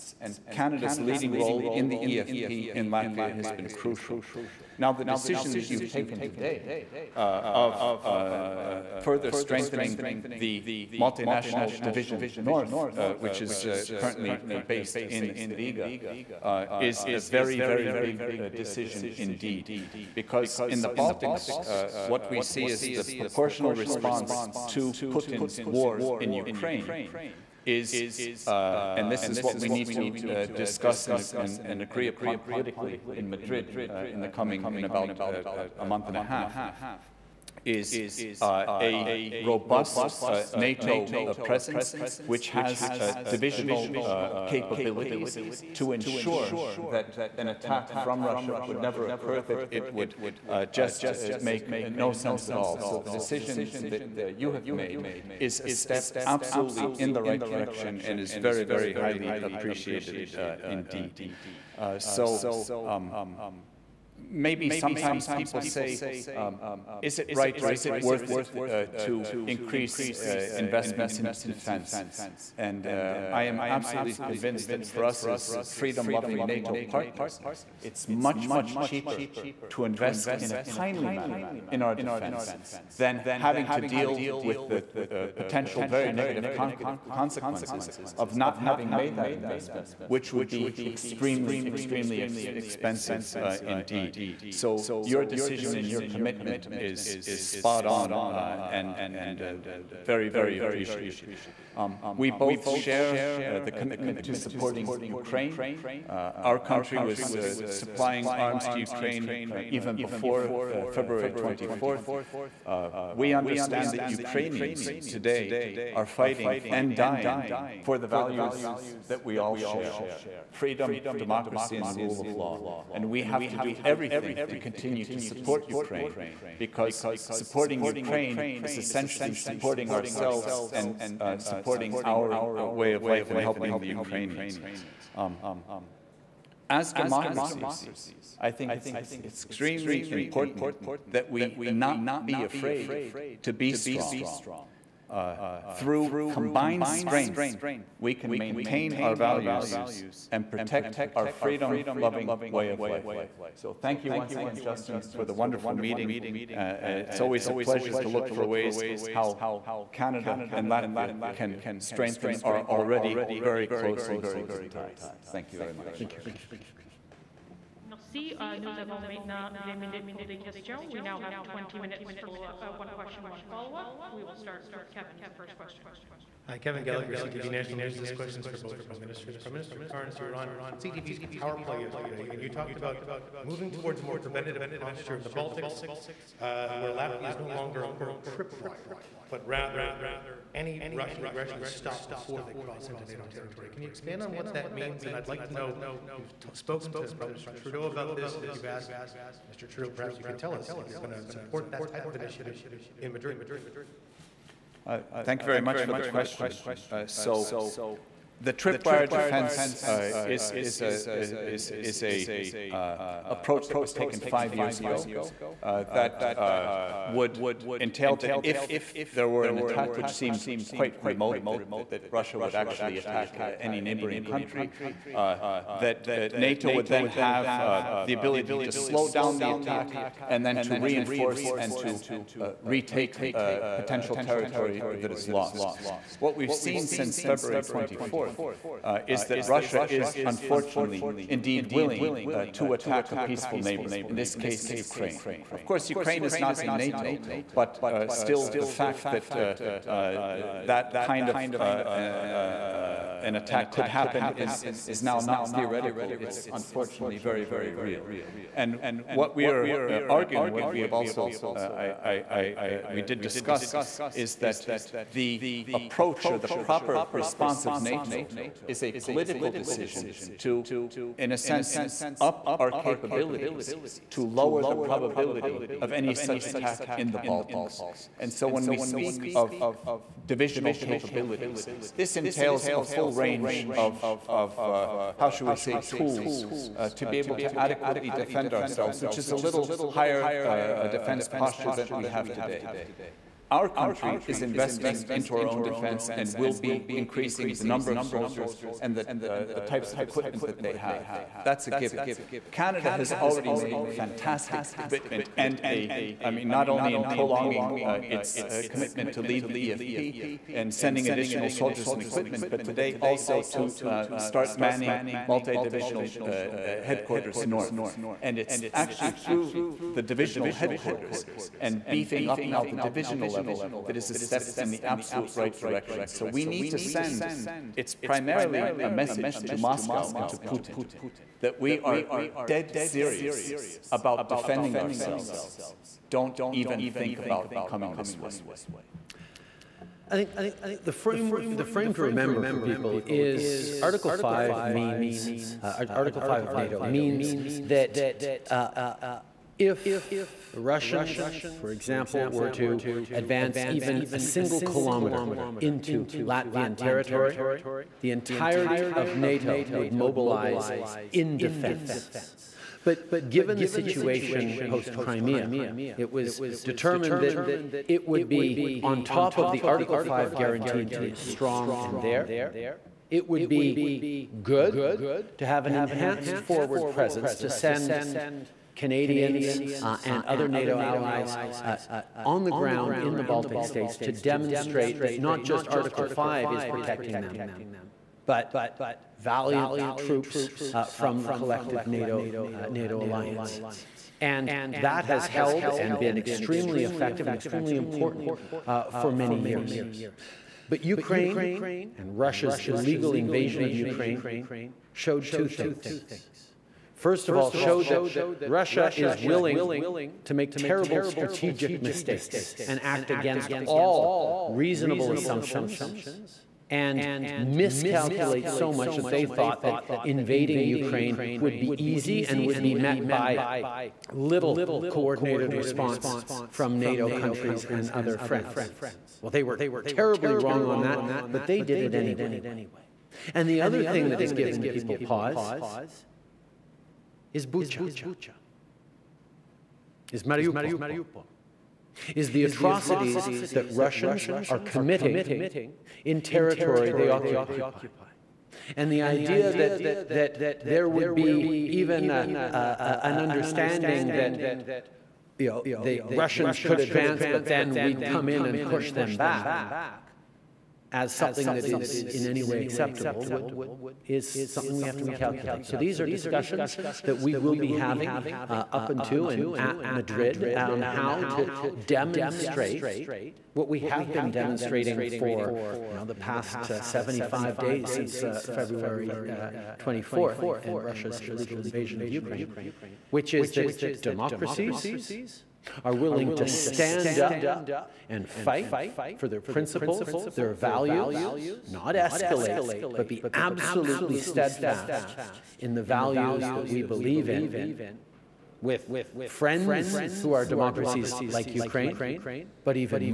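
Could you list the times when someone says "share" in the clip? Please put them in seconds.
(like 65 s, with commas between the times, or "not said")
102 s, 119 s.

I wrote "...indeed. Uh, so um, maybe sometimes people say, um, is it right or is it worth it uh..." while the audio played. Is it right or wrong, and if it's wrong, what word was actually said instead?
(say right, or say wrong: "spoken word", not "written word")
right.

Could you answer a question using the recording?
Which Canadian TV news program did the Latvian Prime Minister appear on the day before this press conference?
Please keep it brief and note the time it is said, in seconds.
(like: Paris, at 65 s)
Power Play, at 181 s.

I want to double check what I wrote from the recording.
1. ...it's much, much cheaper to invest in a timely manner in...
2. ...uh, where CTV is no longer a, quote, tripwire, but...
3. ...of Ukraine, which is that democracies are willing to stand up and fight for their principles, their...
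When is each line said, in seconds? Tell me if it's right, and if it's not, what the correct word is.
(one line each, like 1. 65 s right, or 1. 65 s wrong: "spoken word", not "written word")
1. 77 s right
2. 186 s wrong: "Latvia", not "CTV"
3. 482 s right.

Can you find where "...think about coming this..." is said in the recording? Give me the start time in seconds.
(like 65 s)
336 s.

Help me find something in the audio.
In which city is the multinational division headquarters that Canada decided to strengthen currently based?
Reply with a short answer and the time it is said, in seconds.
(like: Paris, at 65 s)
Riga, at 15 s.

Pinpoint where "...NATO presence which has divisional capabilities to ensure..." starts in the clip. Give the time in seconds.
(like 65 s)
40 s.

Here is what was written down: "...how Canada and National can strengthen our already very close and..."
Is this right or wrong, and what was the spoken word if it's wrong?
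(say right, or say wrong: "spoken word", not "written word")
wrong: "Latvia", not "National".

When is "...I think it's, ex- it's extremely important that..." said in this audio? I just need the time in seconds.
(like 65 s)
138 s.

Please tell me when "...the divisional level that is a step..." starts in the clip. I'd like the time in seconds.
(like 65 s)
322 s.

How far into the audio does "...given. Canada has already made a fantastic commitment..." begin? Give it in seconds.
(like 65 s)
301 s.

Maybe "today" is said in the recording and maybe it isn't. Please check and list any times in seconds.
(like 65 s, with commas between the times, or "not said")
6 s, 115 s, 292 s, 312 s.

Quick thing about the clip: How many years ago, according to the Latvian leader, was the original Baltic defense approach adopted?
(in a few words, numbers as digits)
5.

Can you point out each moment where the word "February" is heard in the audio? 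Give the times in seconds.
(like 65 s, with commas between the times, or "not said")
110 s, 237 s, 478 s.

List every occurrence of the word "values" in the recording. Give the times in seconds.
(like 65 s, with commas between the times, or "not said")
118 s, 149 s, 490 s, 495 s.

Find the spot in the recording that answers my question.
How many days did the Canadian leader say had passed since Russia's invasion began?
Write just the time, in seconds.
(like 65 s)
476 s.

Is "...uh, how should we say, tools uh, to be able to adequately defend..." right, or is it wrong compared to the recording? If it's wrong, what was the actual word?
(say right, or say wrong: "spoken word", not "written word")
right.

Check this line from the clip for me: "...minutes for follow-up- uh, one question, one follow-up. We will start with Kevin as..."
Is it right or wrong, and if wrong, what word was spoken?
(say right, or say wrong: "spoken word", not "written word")
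right.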